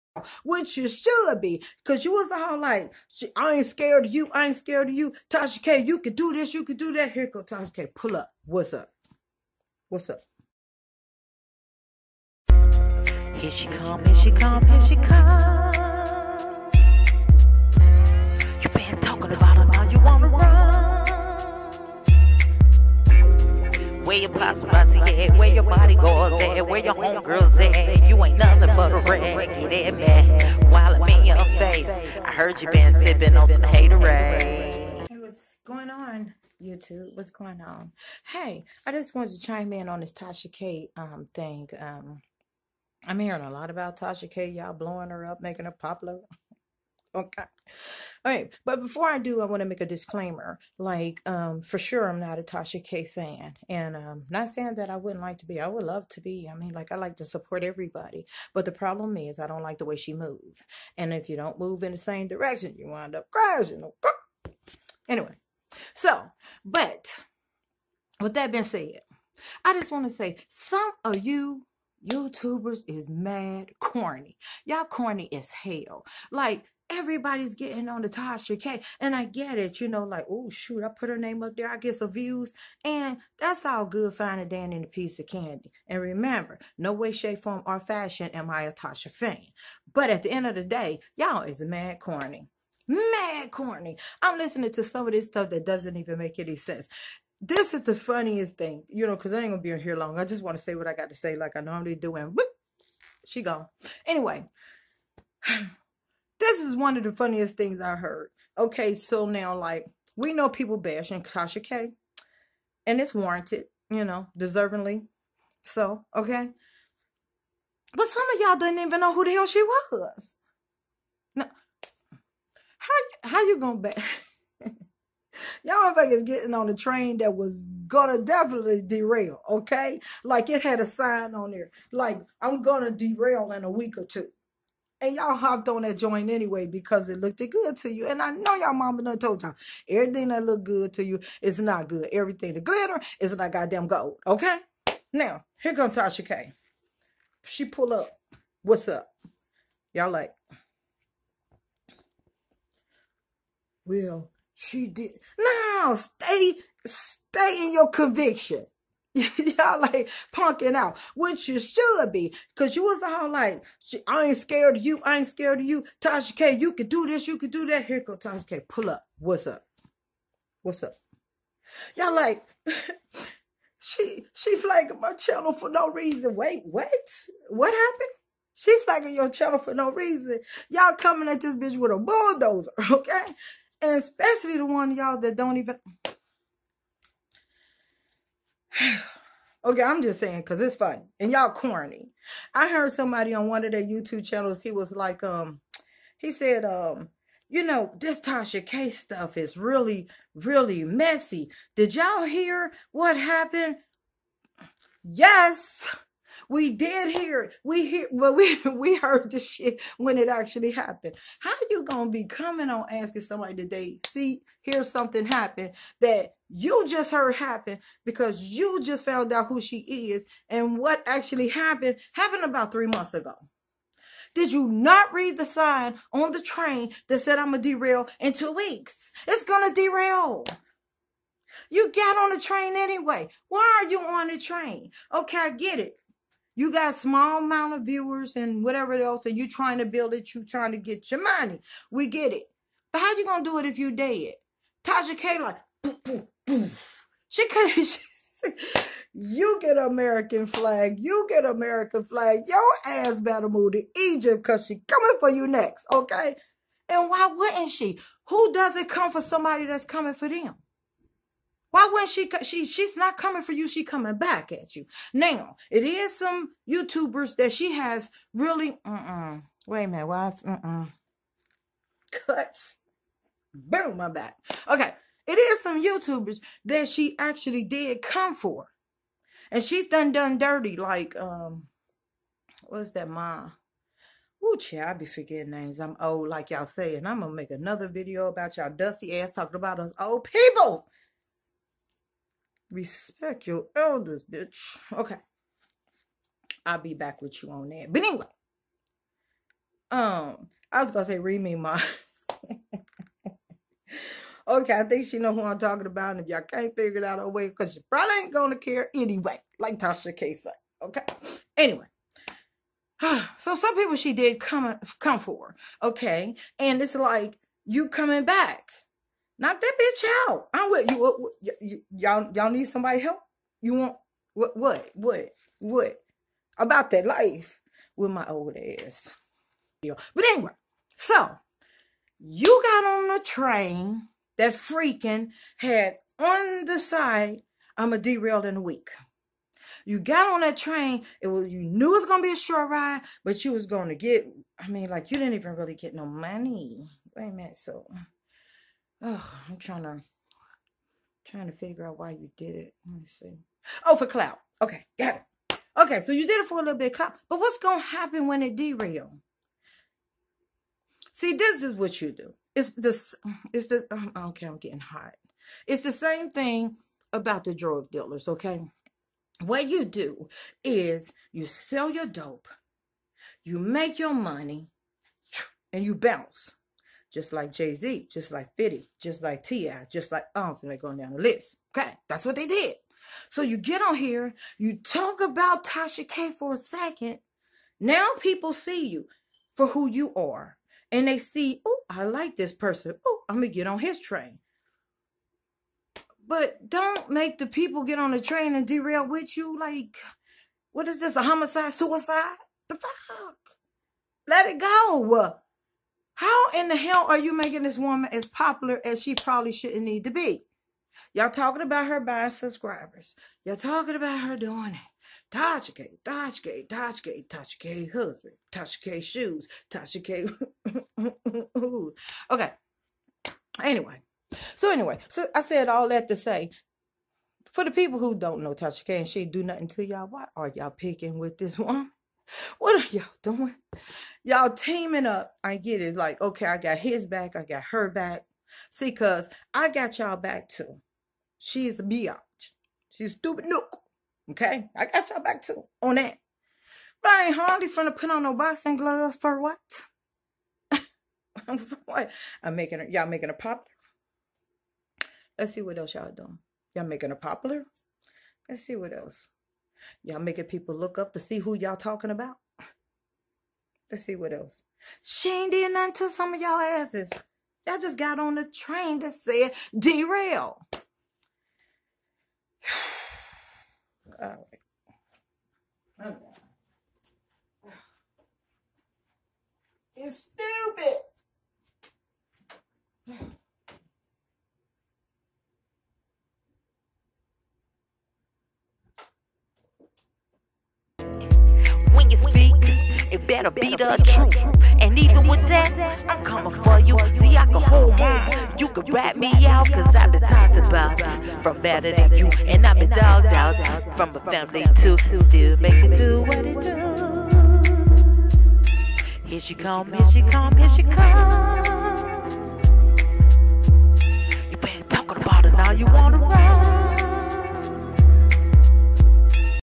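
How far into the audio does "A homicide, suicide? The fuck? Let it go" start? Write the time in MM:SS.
06:41.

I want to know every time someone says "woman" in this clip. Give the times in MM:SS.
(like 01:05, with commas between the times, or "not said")
06:47, 07:11.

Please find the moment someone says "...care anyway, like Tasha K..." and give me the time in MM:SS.
05:08.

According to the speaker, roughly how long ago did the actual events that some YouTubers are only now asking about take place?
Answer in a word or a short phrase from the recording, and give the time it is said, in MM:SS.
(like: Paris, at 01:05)
three months ago, at 03:42.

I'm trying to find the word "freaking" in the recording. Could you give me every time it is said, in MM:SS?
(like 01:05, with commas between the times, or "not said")
05:34.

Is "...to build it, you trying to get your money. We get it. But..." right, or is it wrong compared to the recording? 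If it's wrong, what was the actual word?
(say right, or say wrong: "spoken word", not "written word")
right.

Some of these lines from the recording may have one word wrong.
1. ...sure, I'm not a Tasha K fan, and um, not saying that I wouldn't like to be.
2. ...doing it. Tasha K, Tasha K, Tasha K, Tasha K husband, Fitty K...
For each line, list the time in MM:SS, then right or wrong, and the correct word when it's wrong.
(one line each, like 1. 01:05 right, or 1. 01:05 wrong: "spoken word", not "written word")
1. 00:51 right
2. 06:54 wrong: "Tasha", not "Fitty".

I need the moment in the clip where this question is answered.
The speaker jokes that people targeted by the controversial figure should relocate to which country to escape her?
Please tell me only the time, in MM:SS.
04:13.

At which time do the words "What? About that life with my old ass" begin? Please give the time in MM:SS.
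05:25.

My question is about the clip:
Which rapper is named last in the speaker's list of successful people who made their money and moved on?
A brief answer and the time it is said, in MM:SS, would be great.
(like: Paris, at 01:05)
T.I., at 06:19.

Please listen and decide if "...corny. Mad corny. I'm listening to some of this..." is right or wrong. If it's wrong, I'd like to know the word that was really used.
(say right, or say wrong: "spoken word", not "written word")
right.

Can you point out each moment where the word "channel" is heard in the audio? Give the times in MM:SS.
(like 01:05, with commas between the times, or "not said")
02:55, 02:59, 03:14.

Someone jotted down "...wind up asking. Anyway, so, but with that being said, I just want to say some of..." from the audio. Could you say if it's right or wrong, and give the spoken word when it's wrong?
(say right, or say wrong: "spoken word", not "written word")
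wrong: "crashing", not "asking".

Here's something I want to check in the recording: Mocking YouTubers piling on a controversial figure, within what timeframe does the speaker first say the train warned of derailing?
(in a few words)
a week or two.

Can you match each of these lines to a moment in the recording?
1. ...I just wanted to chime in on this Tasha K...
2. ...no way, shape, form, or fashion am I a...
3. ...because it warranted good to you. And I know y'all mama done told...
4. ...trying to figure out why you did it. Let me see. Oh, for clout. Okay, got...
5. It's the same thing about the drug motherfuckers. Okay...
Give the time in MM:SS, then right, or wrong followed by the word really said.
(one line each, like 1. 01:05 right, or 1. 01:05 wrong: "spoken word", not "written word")
1. 00:38 right
2. 01:26 right
3. 02:16 wrong: "looked", not "warranted"
4. 05:51 right
5. 06:05 wrong: "dealers", not "motherfuckers".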